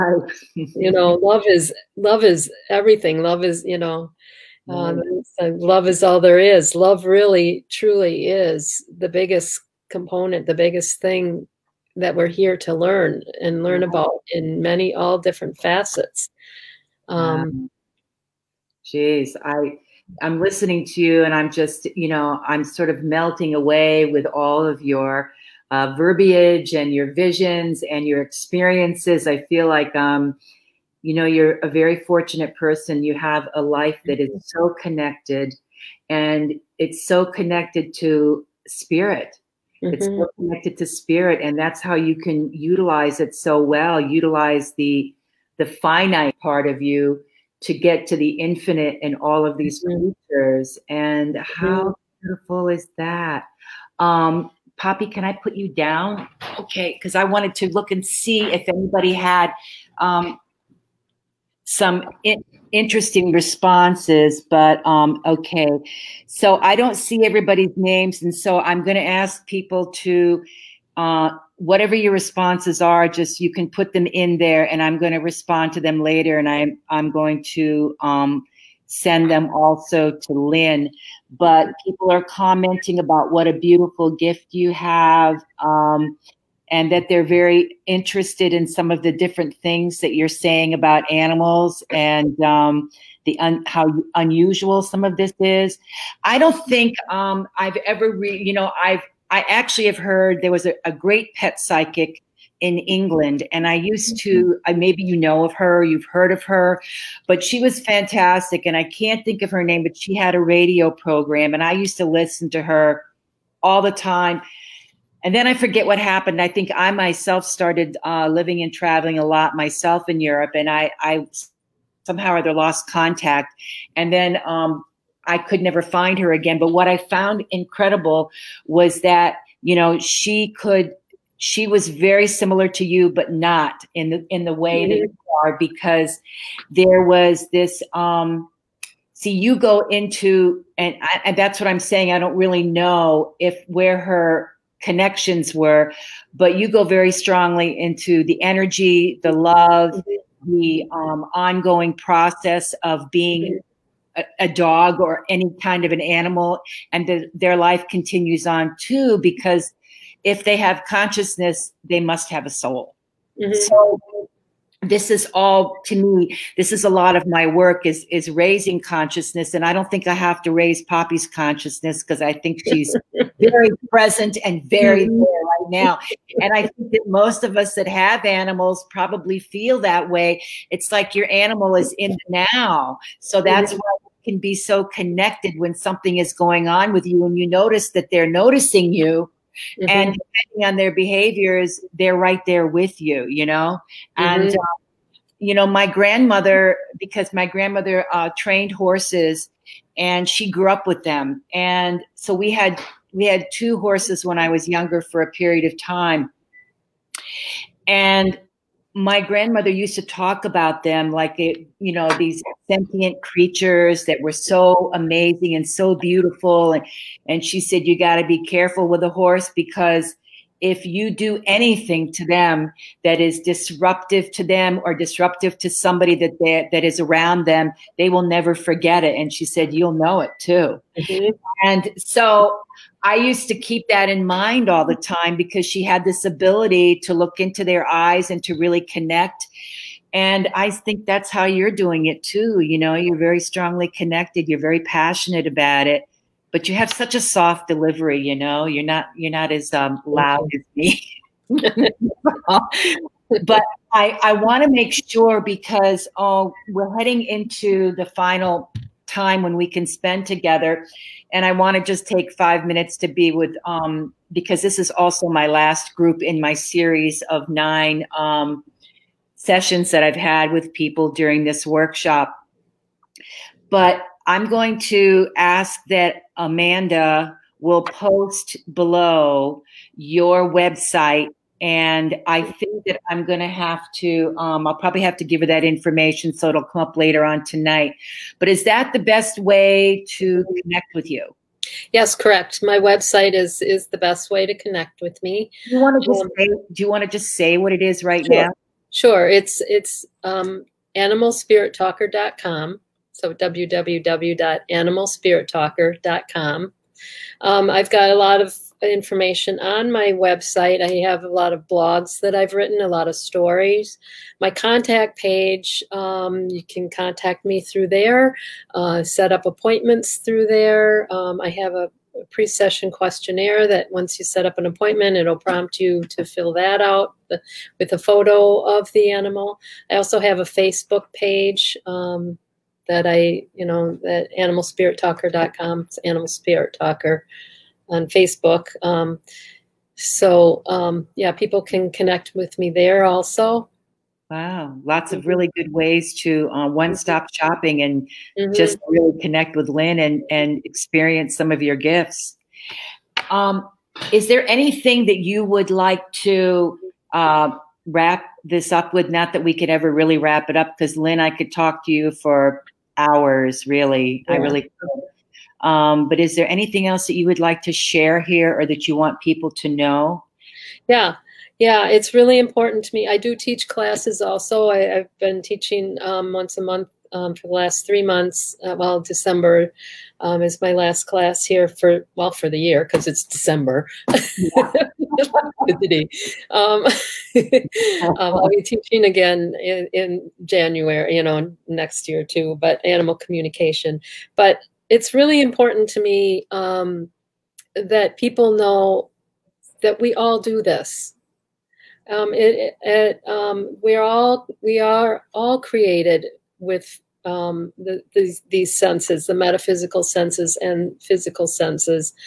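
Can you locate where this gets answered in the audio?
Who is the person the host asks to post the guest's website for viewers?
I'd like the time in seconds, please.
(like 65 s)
276 s.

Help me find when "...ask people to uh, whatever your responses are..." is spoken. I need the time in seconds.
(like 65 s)
69 s.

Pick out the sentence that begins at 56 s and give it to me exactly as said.
Okay, because I wanted to look and see if anybody had um, some in interesting responses, but um, okay.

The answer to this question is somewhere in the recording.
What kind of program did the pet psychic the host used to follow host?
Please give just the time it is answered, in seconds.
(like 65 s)
110 s.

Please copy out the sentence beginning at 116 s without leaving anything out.
I think I myself started uh, living and traveling a lot myself in Europe, and I, I somehow or other lost contact.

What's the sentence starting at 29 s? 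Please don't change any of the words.
I feel like, um, you know, you're a very fortunate person.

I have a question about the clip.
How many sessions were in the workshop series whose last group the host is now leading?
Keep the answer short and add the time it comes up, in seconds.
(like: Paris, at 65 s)
9, at 267 s.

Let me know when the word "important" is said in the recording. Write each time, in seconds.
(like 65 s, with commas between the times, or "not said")
372 s, 395 s.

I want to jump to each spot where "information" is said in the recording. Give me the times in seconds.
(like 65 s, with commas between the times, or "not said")
285 s, 308 s.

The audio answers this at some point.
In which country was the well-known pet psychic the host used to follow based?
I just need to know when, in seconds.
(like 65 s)
102 s.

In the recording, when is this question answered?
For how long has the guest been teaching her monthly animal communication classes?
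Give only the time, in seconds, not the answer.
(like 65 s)
377 s.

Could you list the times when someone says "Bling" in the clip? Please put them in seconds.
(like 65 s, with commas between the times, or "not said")
not said.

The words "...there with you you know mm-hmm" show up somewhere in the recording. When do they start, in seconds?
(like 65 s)
192 s.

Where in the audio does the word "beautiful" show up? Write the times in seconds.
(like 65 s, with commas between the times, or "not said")
52 s, 83 s, 215 s.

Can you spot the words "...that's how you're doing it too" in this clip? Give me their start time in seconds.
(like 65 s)
241 s.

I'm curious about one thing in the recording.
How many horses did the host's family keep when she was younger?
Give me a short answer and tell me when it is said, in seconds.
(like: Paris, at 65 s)
2, at 203 s.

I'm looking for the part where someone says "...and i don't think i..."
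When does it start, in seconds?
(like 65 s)
169 s.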